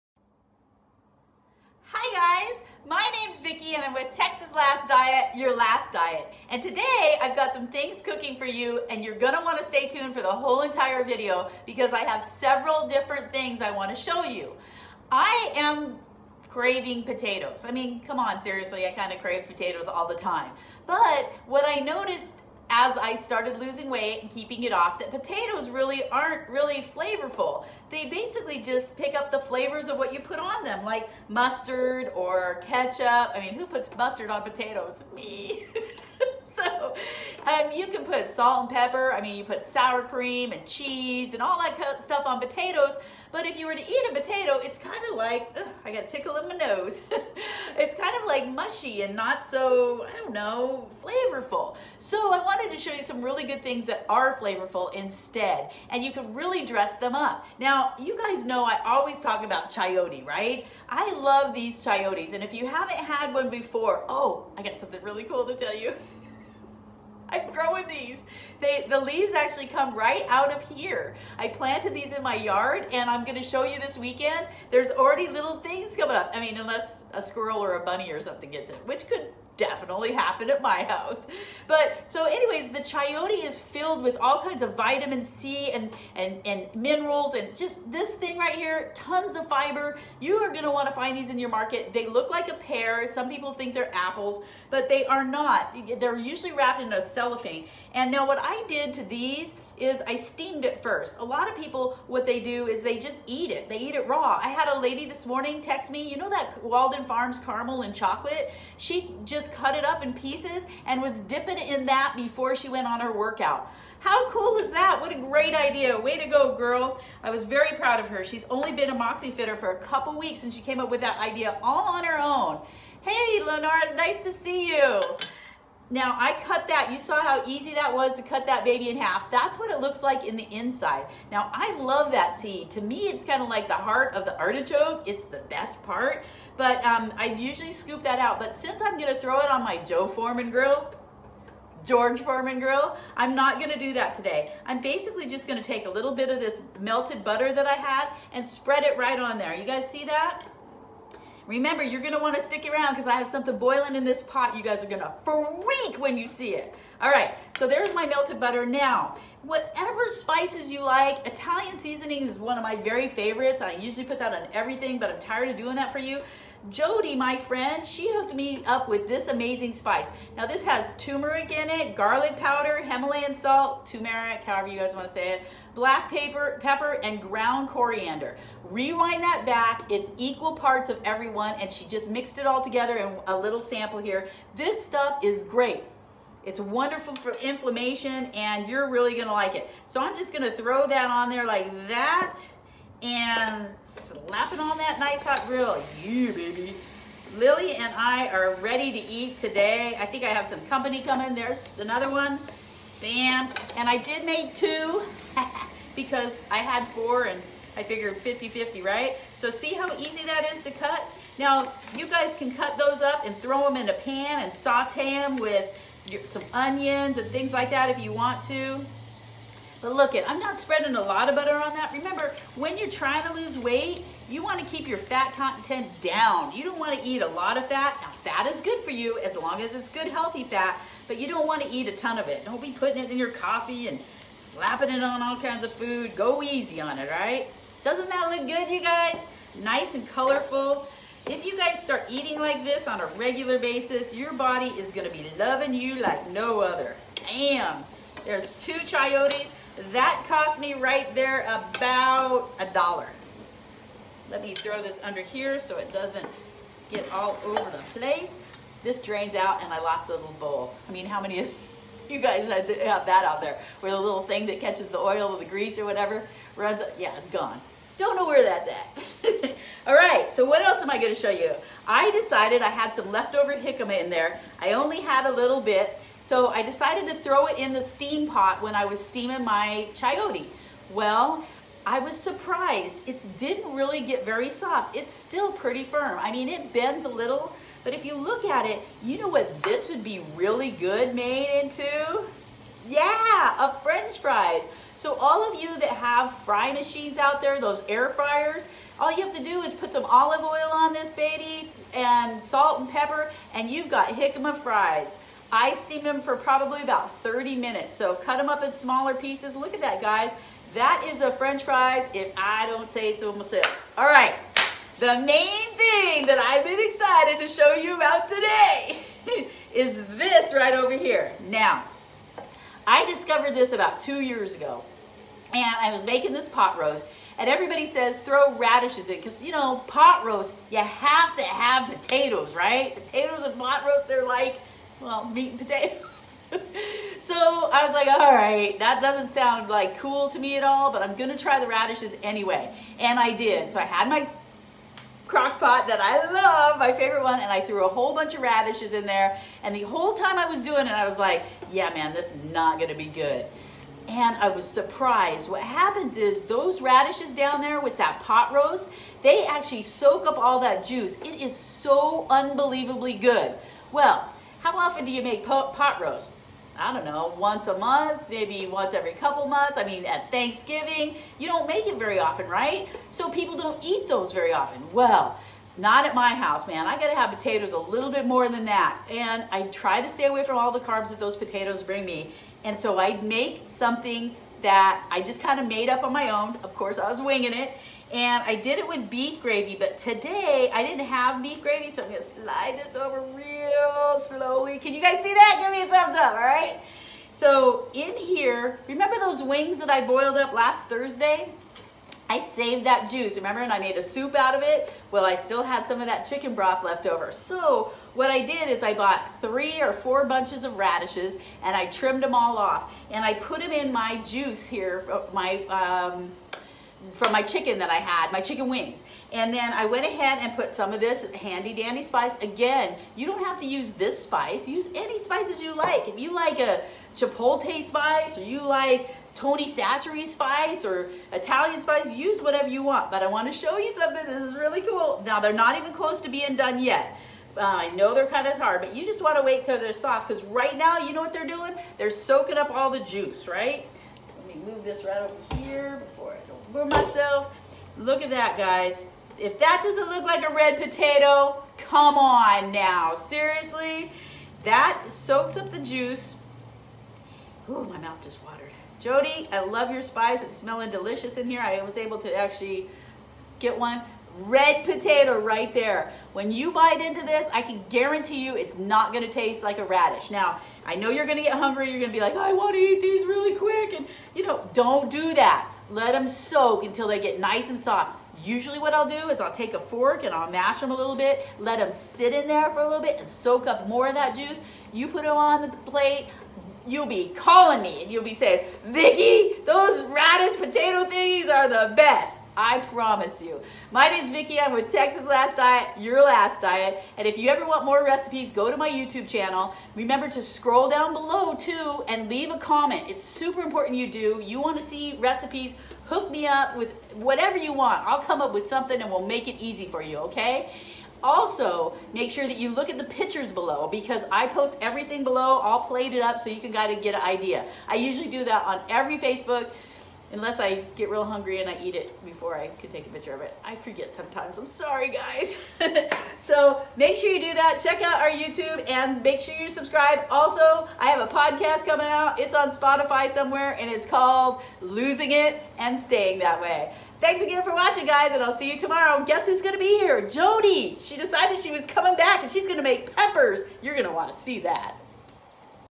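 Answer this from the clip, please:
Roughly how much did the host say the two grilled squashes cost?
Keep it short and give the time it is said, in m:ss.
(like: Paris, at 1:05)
about a dollar, at 4:11.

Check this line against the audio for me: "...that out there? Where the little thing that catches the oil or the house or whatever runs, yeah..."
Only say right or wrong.
wrong.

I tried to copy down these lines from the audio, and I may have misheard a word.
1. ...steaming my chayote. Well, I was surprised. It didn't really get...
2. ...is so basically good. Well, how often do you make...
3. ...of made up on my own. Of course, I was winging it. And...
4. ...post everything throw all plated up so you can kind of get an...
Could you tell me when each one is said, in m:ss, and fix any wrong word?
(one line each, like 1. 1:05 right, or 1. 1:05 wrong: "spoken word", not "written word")
1. 4:39 right
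2. 6:01 wrong: "unbelievably", not "basically"
3. 6:25 right
4. 8:34 wrong: "below", not "throw".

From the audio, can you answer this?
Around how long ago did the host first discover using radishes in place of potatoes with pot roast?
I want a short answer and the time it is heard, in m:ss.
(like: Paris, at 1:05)
about two years, at 5:23.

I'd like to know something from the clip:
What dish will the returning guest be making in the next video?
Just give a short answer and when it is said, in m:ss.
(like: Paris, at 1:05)
peppers, at 9:03.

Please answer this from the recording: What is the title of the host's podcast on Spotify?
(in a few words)
Losing It and Staying That Way.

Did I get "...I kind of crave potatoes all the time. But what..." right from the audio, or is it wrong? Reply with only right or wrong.
right.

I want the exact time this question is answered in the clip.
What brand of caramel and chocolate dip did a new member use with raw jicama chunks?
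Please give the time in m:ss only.
1:46.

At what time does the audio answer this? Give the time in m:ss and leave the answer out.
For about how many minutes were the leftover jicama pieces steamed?
5:07.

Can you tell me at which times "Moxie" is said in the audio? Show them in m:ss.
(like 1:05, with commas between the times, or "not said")
1:58.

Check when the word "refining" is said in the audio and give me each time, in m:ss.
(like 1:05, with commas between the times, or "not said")
not said.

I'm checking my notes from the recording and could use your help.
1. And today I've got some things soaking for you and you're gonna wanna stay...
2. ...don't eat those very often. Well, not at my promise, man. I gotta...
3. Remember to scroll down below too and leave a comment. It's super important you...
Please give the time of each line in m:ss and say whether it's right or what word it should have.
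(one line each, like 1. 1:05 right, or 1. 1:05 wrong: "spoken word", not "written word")
1. 0:06 wrong: "cooking", not "soaking"
2. 6:13 wrong: "house", not "promise"
3. 8:19 right.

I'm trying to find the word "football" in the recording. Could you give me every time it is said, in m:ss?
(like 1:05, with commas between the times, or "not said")
not said.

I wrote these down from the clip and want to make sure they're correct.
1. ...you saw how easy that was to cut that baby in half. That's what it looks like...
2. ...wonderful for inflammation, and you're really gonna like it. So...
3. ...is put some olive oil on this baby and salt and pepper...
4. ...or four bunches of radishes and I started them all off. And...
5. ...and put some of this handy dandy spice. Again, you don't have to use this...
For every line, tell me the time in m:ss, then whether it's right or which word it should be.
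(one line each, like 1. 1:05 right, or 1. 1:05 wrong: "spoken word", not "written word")
1. 2:06 right
2. 3:06 right
3. 4:59 right
4. 6:49 wrong: "trimmed", not "started"
5. 7:00 right.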